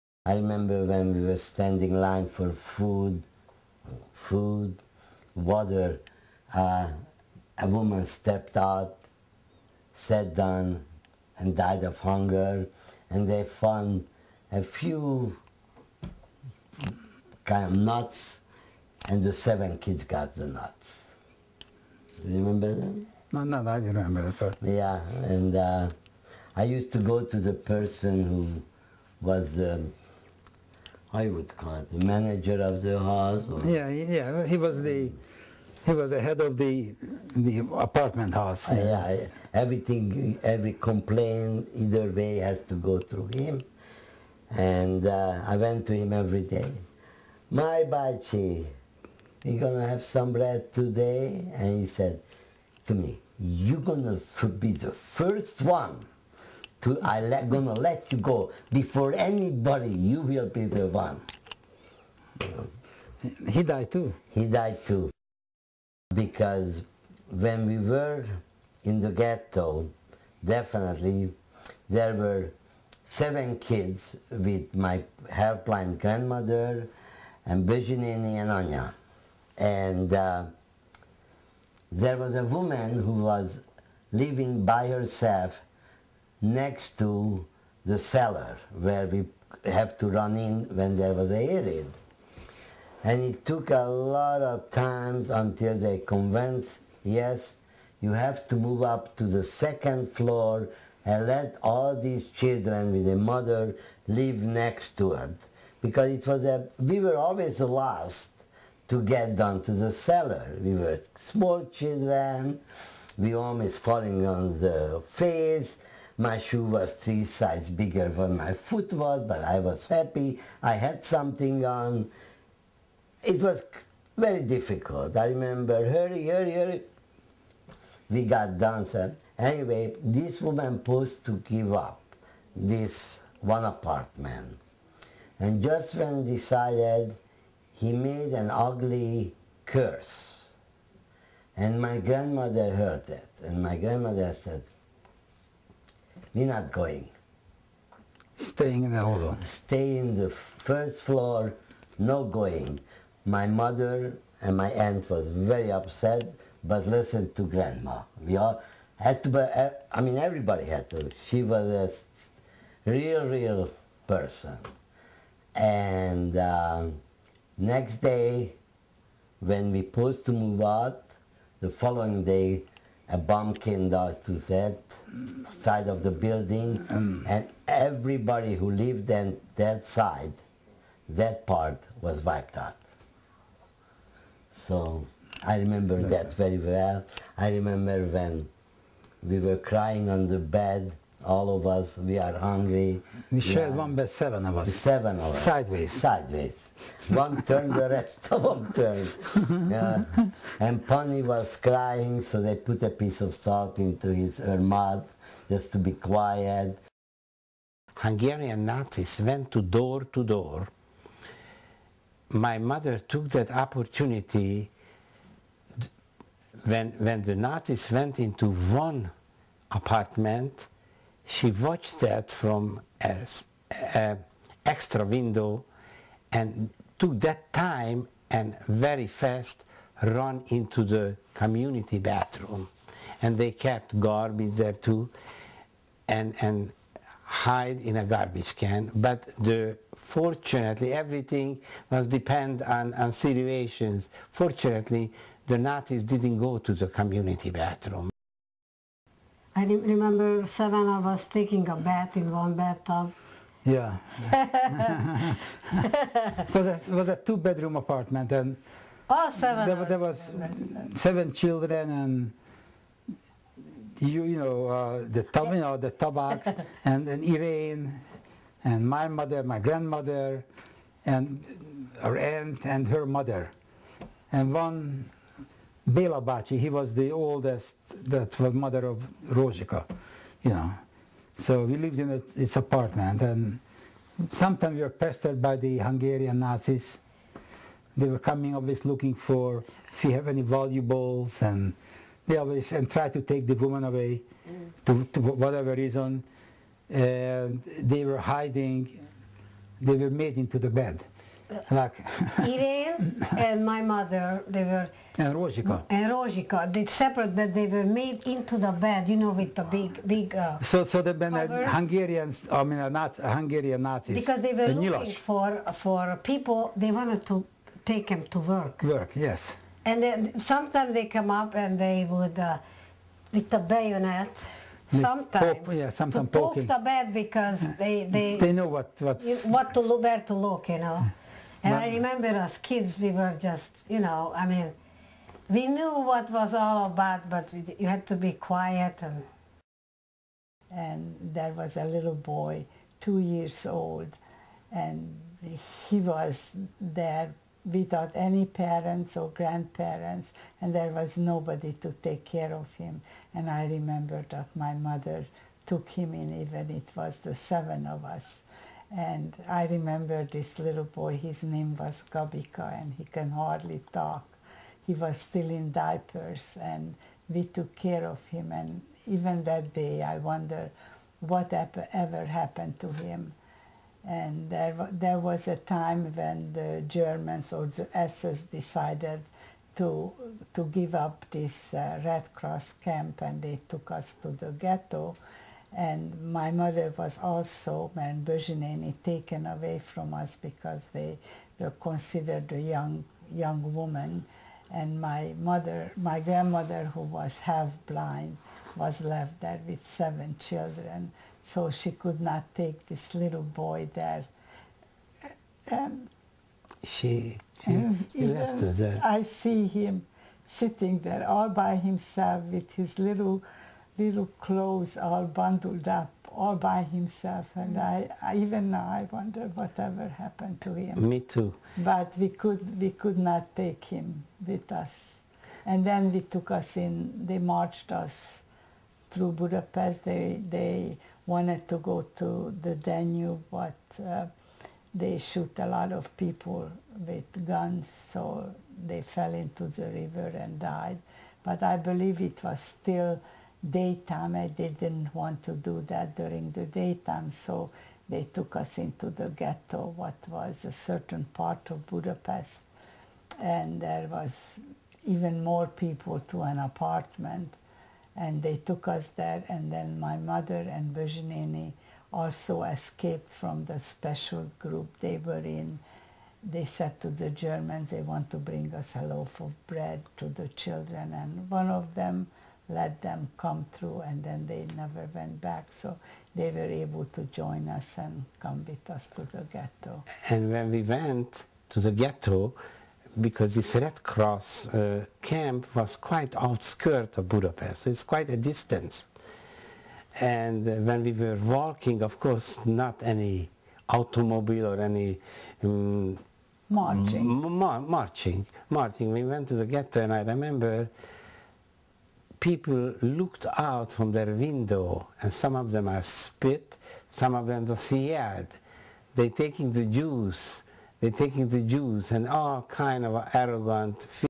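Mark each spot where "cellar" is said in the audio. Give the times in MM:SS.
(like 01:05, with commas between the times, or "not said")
01:27, 01:49.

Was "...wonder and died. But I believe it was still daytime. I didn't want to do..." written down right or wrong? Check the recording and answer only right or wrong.
wrong.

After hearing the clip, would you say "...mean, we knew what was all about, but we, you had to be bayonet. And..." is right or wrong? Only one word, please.
wrong.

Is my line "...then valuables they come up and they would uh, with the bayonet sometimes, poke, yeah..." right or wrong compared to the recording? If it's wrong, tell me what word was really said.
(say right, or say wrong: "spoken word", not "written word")
wrong: "sometimes", not "valuables".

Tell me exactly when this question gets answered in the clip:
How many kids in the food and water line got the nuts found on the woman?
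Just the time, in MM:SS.
00:19.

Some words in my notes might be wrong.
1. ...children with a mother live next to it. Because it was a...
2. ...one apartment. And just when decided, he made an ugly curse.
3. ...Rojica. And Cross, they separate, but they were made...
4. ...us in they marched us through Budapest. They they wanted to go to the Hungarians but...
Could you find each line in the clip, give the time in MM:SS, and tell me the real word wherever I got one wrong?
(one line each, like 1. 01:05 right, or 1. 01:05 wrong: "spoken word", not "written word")
1. 01:42 right
2. 02:13 right
3. 05:05 wrong: "Rojica", not "Cross"
4. 07:06 wrong: "Danube", not "Hungarians".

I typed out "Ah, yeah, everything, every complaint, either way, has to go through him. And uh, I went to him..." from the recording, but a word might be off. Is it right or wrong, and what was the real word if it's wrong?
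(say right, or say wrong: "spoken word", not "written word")
right.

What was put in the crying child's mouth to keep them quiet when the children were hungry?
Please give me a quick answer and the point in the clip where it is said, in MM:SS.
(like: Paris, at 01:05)
salt, at 03:22.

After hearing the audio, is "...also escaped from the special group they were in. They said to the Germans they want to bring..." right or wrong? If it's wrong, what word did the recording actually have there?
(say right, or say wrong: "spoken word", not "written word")
right.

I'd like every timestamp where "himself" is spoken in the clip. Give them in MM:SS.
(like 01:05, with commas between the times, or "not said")
06:51, 06:56.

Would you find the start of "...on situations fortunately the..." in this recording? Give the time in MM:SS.
04:02.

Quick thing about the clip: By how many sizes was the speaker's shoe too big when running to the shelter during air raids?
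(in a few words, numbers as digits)
3.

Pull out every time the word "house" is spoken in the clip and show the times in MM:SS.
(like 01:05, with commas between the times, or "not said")
00:32, 00:38.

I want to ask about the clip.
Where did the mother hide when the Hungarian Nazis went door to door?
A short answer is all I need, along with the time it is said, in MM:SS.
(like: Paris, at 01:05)
garbage can, at 03:58.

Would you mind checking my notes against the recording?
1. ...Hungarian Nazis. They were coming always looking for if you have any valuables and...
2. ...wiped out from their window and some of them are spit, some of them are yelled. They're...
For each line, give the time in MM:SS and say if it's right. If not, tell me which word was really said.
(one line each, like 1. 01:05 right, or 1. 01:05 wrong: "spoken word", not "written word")
1. 04:45 right
2. 08:23 wrong: "looked", not "wiped".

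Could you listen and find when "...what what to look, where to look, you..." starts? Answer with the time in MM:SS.
05:28.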